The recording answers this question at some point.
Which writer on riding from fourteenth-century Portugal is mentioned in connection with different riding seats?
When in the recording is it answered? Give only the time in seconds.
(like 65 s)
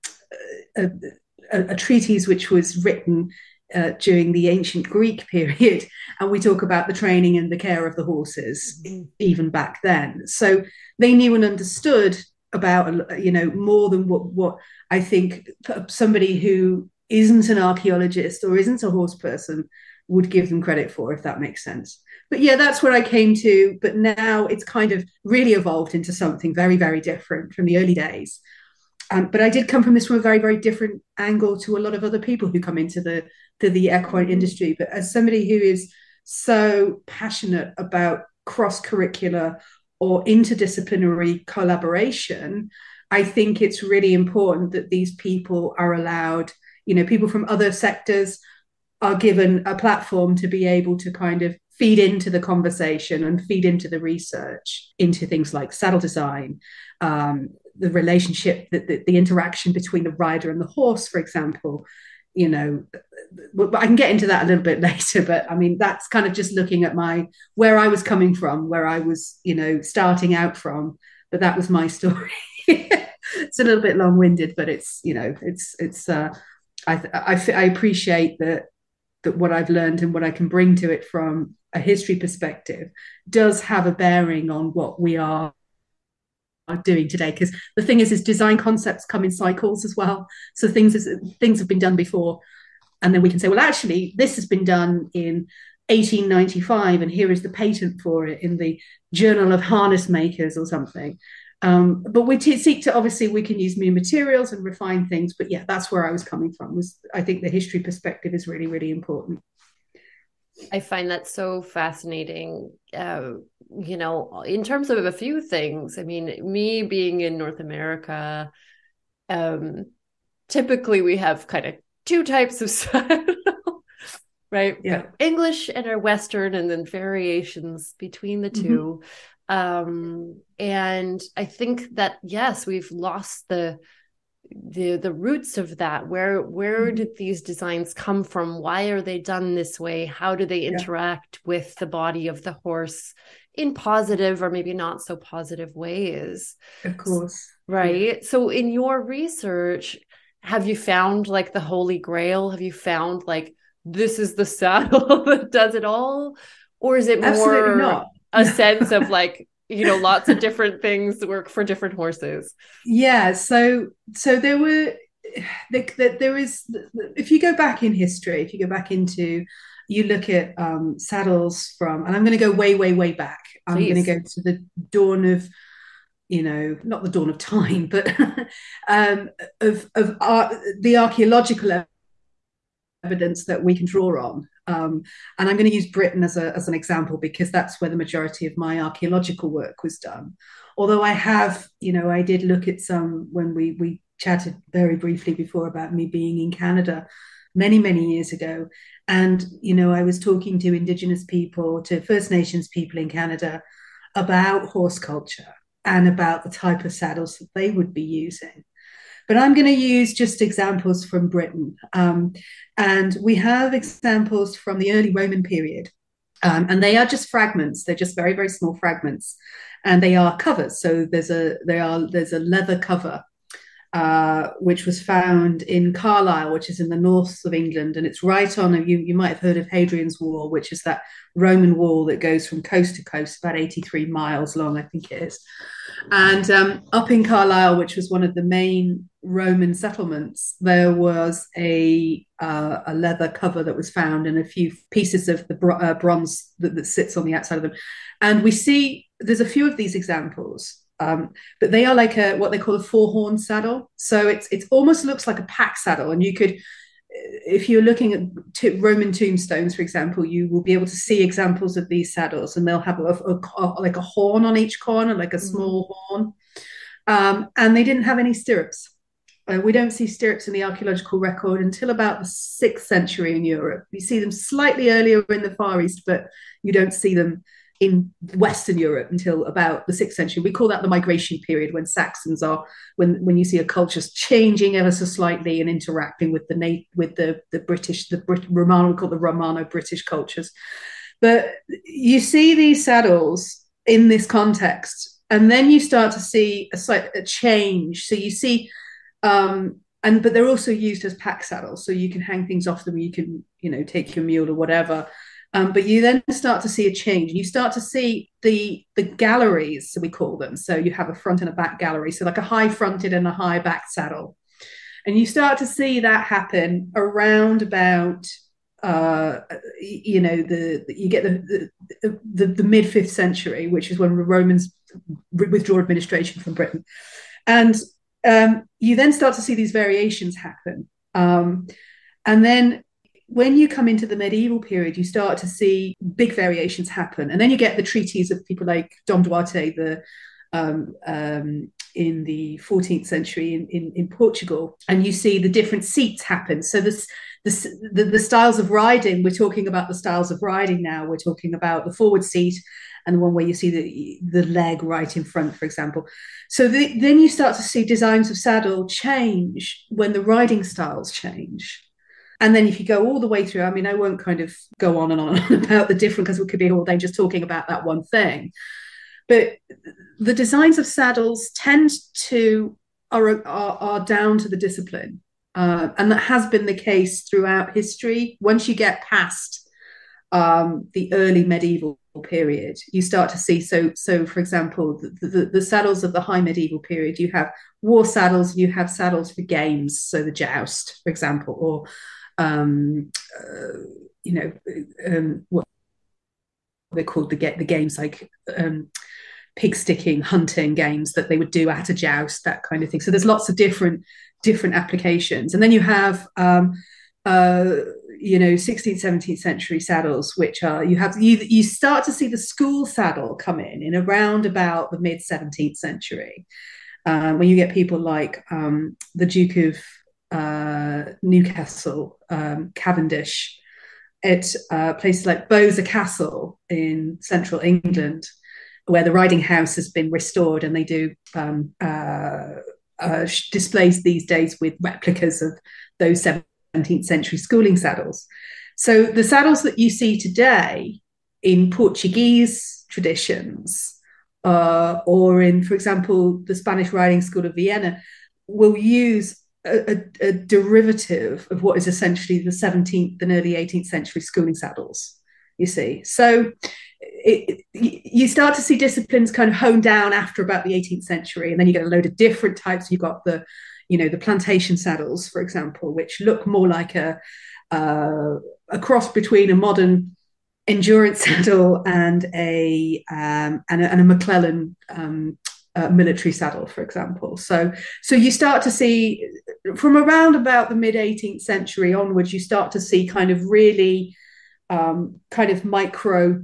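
339 s.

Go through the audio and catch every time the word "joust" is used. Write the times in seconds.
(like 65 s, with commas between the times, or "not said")
390 s, 401 s.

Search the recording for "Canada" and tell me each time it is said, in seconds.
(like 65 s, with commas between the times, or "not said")
196 s, 203 s.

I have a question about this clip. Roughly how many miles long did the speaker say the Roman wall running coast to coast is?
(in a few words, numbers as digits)
83.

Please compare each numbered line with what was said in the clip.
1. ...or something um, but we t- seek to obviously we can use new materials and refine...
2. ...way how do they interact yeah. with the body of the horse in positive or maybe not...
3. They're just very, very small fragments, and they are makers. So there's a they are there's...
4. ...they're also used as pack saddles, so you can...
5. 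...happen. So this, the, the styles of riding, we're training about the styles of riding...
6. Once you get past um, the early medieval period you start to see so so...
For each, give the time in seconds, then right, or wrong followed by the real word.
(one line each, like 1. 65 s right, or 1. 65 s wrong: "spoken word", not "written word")
1. 100 s right
2. 139 s right
3. 217 s wrong: "covers", not "makers"
4. 300 s right
5. 346 s wrong: "talking", not "training"
6. 378 s right.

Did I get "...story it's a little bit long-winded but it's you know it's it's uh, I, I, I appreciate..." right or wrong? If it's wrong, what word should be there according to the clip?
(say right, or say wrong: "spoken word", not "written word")
right.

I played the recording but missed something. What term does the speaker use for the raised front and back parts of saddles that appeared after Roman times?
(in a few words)
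galleries.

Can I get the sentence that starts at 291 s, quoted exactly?
But you see these saddles in this context, and then you start to see a slight a change.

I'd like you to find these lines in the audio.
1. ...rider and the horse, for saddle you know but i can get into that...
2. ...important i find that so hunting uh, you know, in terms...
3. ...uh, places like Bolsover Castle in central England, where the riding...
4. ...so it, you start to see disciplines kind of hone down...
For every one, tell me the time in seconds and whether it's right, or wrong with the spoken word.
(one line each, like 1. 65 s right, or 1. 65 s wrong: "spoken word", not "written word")
1. 60 s wrong: "example", not "saddle"
2. 108 s wrong: "fascinating", not "hunting"
3. 424 s right
4. 456 s right.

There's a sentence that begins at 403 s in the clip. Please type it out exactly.
So there's lots of different different applications, and then you have.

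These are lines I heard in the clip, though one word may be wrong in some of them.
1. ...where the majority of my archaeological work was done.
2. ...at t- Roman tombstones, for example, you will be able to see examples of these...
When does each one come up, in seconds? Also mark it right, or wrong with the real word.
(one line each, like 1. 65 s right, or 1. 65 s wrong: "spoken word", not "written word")
1. 187 s right
2. 258 s right.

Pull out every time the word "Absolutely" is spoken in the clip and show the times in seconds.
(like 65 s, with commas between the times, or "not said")
157 s.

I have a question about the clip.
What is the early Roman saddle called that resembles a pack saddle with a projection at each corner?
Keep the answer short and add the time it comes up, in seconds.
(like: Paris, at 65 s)
four horn saddle, at 252 s.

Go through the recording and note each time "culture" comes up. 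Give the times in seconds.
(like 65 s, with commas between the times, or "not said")
204 s, 283 s, 290 s.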